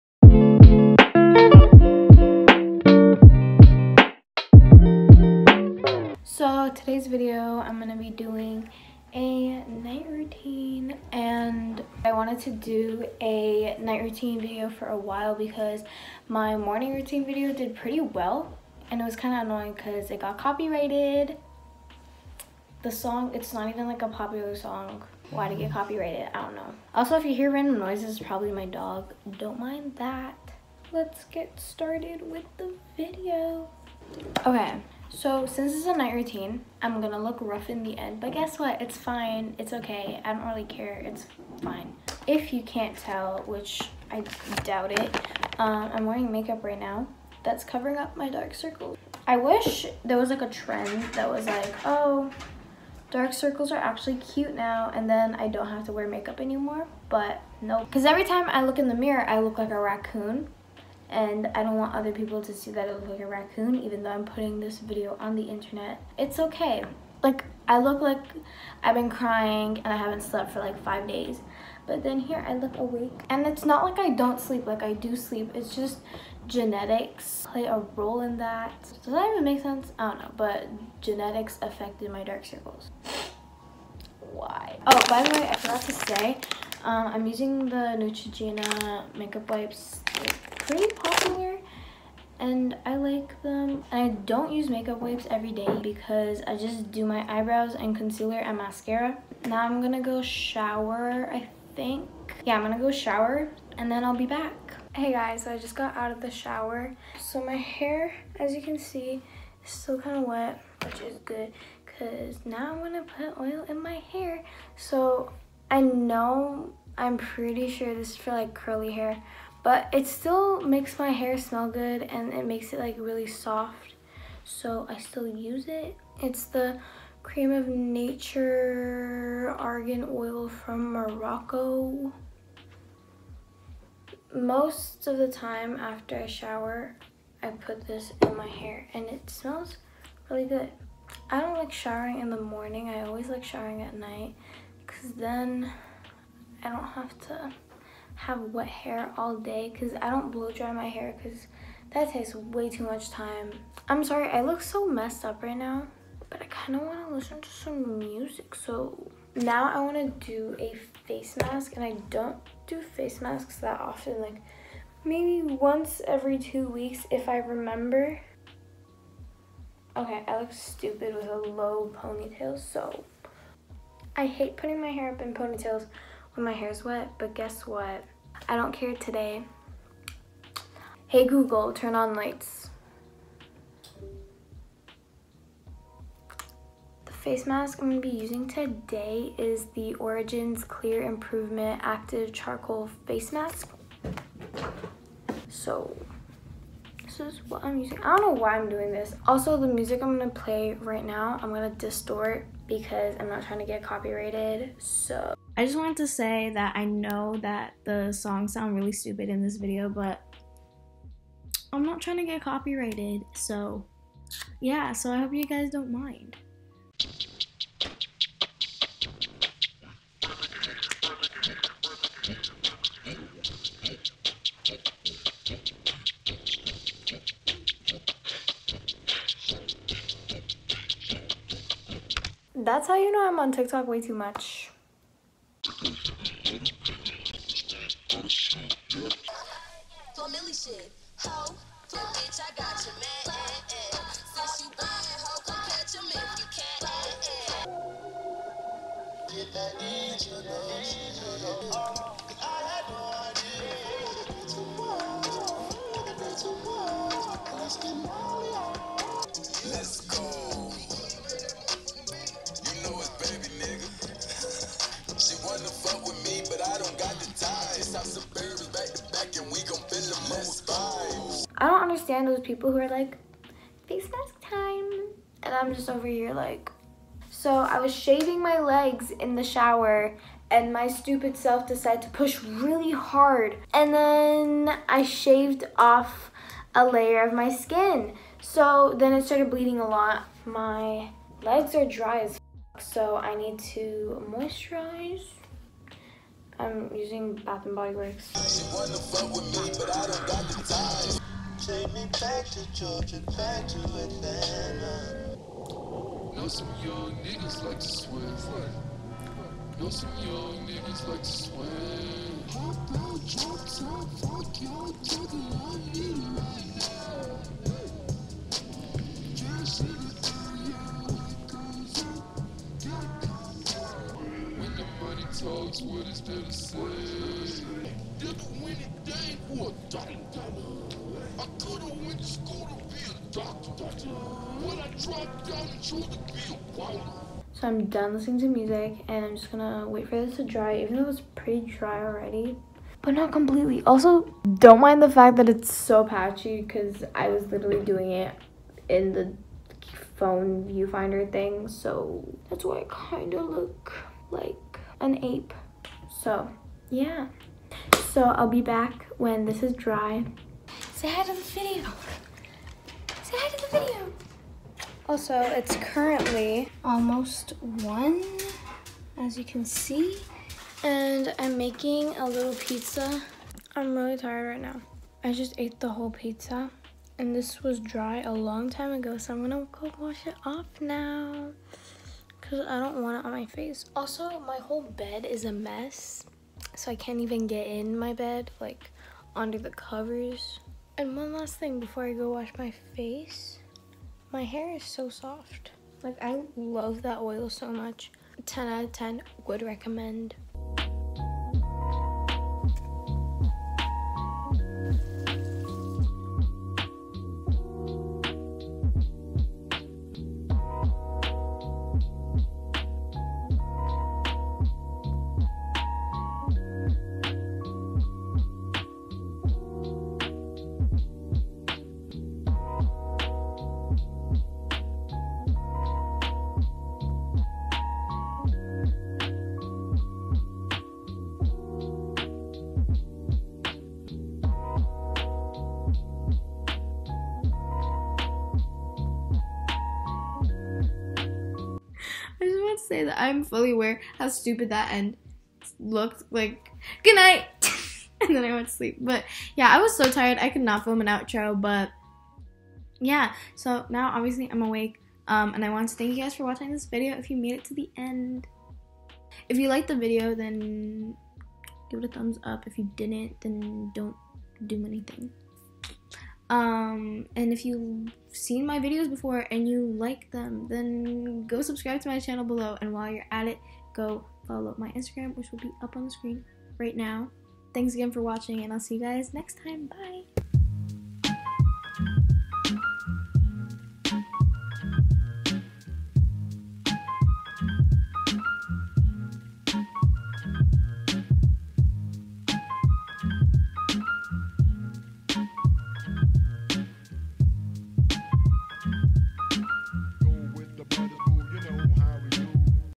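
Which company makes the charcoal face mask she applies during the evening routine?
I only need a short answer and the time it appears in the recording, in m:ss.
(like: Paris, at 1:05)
Origins, at 3:09.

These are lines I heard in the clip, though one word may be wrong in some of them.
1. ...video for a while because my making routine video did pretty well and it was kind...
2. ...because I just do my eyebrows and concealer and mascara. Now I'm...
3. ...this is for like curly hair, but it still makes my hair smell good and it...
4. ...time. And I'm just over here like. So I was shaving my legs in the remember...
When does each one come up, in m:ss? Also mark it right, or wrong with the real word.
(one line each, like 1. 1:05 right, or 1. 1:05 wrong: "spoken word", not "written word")
1. 0:14 wrong: "morning", not "making"
2. 1:35 right
3. 1:57 right
4. 4:34 wrong: "shower", not "remember".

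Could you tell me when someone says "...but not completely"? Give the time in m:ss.
5:43.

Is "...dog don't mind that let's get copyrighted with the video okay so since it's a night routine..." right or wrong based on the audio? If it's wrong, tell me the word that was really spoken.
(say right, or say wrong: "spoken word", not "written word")
wrong: "started", not "copyrighted".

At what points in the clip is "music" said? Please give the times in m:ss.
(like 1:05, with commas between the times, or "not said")
2:37, 3:19, 5:38.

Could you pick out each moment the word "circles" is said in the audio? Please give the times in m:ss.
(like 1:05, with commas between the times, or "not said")
0:48, 0:53, 1:22.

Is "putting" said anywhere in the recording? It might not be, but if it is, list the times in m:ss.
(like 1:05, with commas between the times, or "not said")
1:04, 2:54.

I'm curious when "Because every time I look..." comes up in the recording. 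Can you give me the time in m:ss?
0:57.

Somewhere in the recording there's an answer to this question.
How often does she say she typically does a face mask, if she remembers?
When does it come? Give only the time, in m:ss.
2:45.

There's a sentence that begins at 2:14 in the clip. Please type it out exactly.
Most of the time after I shower, I put this in my hair and it smells really good.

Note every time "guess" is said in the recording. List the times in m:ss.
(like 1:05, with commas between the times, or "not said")
0:38, 2:57.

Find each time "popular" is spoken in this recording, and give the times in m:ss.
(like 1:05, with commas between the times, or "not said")
0:24, 1:30.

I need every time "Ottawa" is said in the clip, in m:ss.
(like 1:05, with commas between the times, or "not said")
not said.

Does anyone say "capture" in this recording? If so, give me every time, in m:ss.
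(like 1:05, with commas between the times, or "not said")
not said.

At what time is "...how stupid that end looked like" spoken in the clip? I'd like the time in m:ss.
7:24.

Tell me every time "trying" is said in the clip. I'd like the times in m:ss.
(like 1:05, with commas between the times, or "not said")
3:23, 3:32.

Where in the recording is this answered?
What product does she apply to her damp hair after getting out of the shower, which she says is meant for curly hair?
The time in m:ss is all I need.
2:07.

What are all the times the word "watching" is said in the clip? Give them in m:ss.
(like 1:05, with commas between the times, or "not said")
7:36, 7:58.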